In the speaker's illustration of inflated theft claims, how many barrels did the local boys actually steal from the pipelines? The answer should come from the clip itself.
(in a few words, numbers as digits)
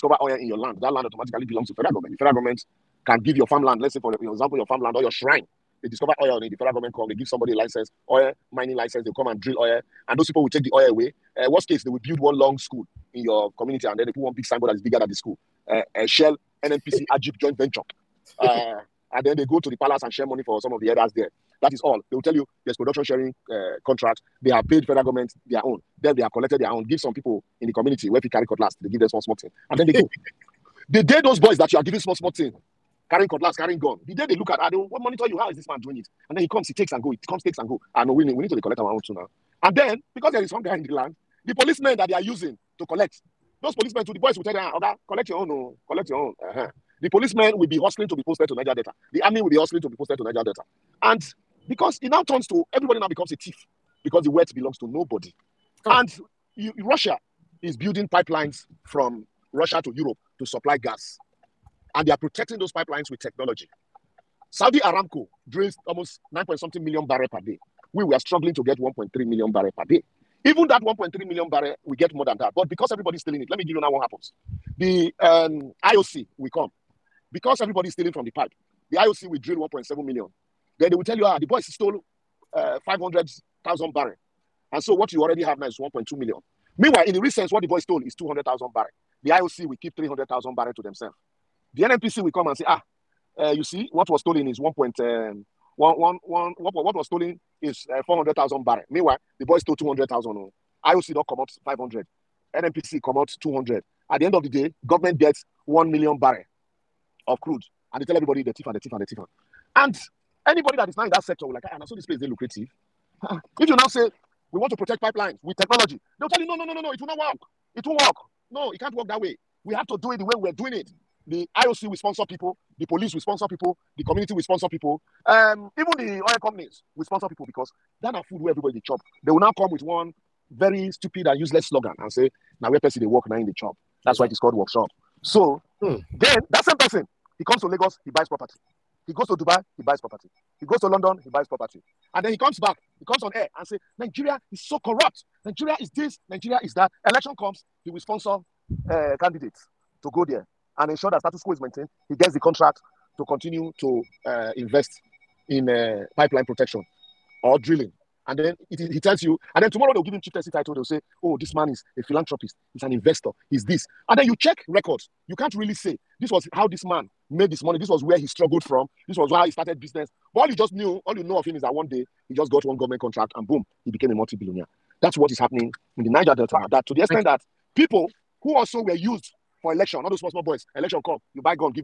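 200,000.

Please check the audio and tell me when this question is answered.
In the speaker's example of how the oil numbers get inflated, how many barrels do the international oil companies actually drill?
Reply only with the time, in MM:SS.
01:19.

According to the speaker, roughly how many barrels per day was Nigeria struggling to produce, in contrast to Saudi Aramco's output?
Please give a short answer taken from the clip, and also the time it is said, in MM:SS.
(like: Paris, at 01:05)
1.3 million, at 01:08.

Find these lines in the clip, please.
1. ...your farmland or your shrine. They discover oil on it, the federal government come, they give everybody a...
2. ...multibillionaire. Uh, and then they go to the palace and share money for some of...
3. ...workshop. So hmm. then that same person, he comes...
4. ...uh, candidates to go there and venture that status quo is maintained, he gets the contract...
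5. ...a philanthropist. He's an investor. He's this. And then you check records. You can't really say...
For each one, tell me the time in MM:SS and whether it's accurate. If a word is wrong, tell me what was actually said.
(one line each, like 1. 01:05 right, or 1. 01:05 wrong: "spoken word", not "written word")
1. 00:04 wrong: "somebody", not "everybody"
2. 00:17 wrong: "venture", not "multibillionaire"
3. 02:14 right
4. 02:28 wrong: "ensure", not "venture"
5. 02:41 right.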